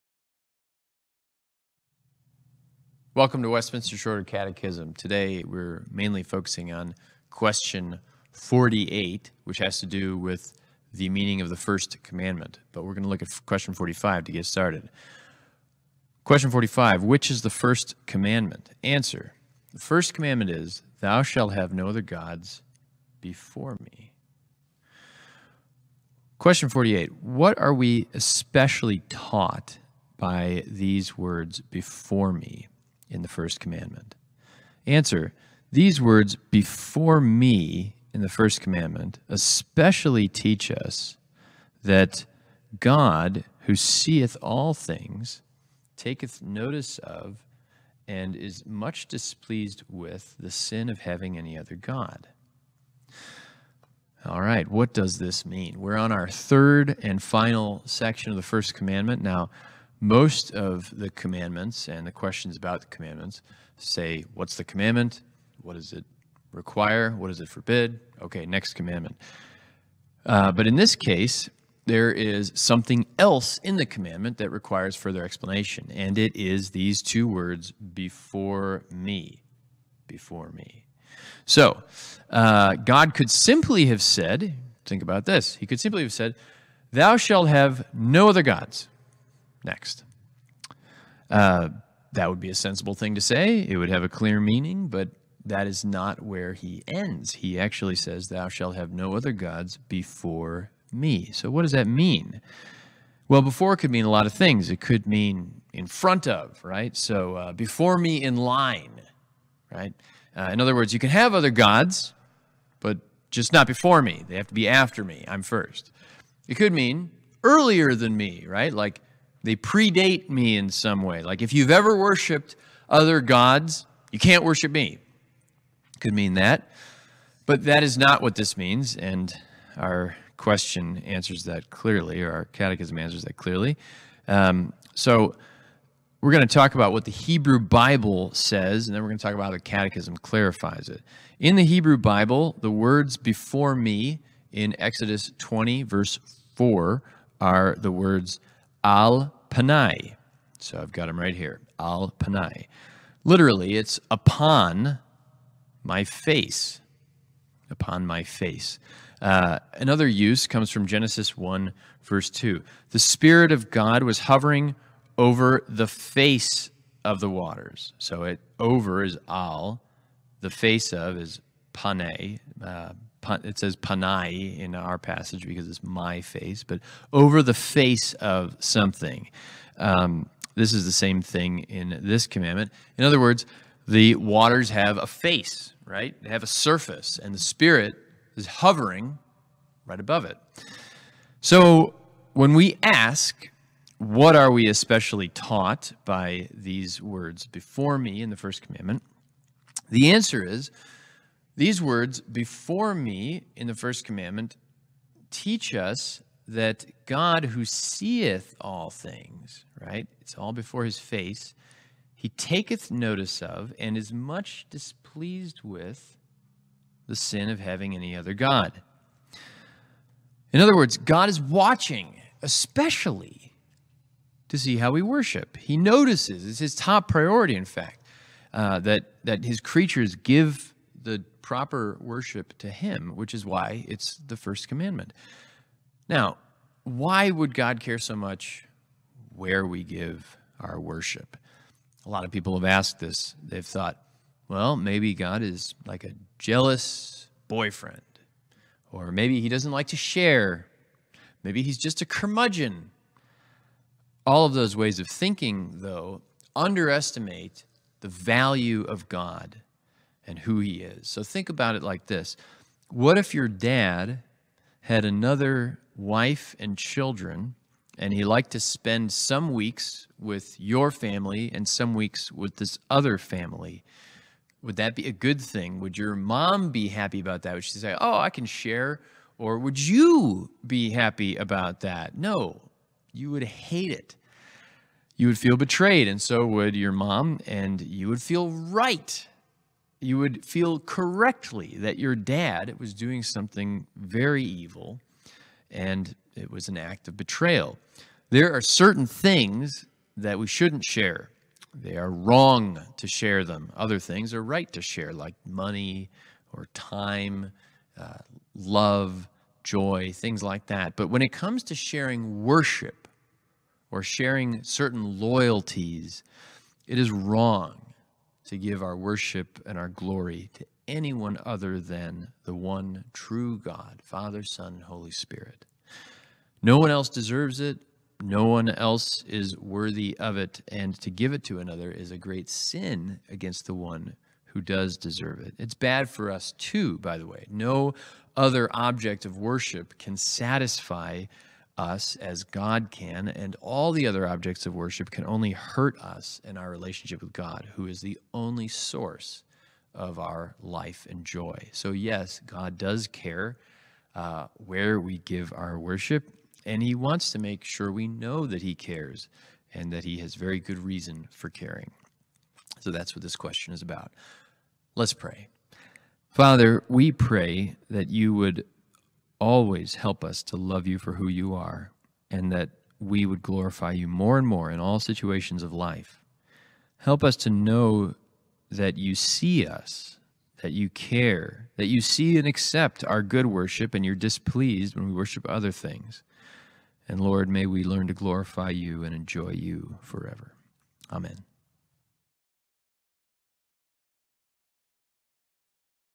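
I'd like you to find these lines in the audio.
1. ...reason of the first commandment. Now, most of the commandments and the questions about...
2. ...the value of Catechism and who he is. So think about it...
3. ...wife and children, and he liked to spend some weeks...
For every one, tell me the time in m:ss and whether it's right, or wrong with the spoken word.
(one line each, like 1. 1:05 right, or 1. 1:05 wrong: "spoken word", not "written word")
1. 0:57 wrong: "section", not "reason"
2. 4:18 wrong: "God", not "Catechism"
3. 4:25 right.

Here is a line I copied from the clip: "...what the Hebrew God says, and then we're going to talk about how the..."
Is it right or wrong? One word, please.
wrong.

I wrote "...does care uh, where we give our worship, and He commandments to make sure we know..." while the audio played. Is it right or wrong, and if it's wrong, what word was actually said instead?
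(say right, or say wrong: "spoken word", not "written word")
wrong: "wants", not "commandments".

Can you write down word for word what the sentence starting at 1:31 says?
Uh, that would be a sensible thing to say.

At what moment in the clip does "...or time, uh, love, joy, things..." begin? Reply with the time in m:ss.
5:06.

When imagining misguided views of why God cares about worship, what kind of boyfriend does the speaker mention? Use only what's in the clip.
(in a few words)
Jealous.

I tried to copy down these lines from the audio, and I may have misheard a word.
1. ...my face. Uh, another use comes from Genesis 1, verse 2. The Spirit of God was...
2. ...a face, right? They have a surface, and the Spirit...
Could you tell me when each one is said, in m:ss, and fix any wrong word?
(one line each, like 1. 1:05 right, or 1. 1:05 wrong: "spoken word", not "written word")
1. 2:38 right
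2. 3:04 right.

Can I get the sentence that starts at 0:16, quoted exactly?
Question 45 Which is the first commandment?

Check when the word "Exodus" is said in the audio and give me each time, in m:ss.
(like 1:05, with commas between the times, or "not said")
2:24.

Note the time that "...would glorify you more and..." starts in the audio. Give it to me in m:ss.
6:13.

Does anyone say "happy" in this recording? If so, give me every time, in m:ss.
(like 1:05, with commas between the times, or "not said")
4:36, 4:40.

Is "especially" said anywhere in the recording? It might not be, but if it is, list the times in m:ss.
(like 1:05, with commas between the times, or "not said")
0:28, 0:39, 3:14, 3:42.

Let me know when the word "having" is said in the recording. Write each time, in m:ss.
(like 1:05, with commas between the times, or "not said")
0:50, 3:37.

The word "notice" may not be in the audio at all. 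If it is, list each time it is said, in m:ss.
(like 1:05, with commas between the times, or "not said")
0:46, 3:32, 3:45.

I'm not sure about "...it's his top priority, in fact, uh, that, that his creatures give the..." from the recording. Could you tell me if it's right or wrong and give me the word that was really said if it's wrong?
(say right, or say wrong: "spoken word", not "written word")
right.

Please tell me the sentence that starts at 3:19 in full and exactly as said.
The answer is these words before me in the first commandment teach us that God who seeth all things, right?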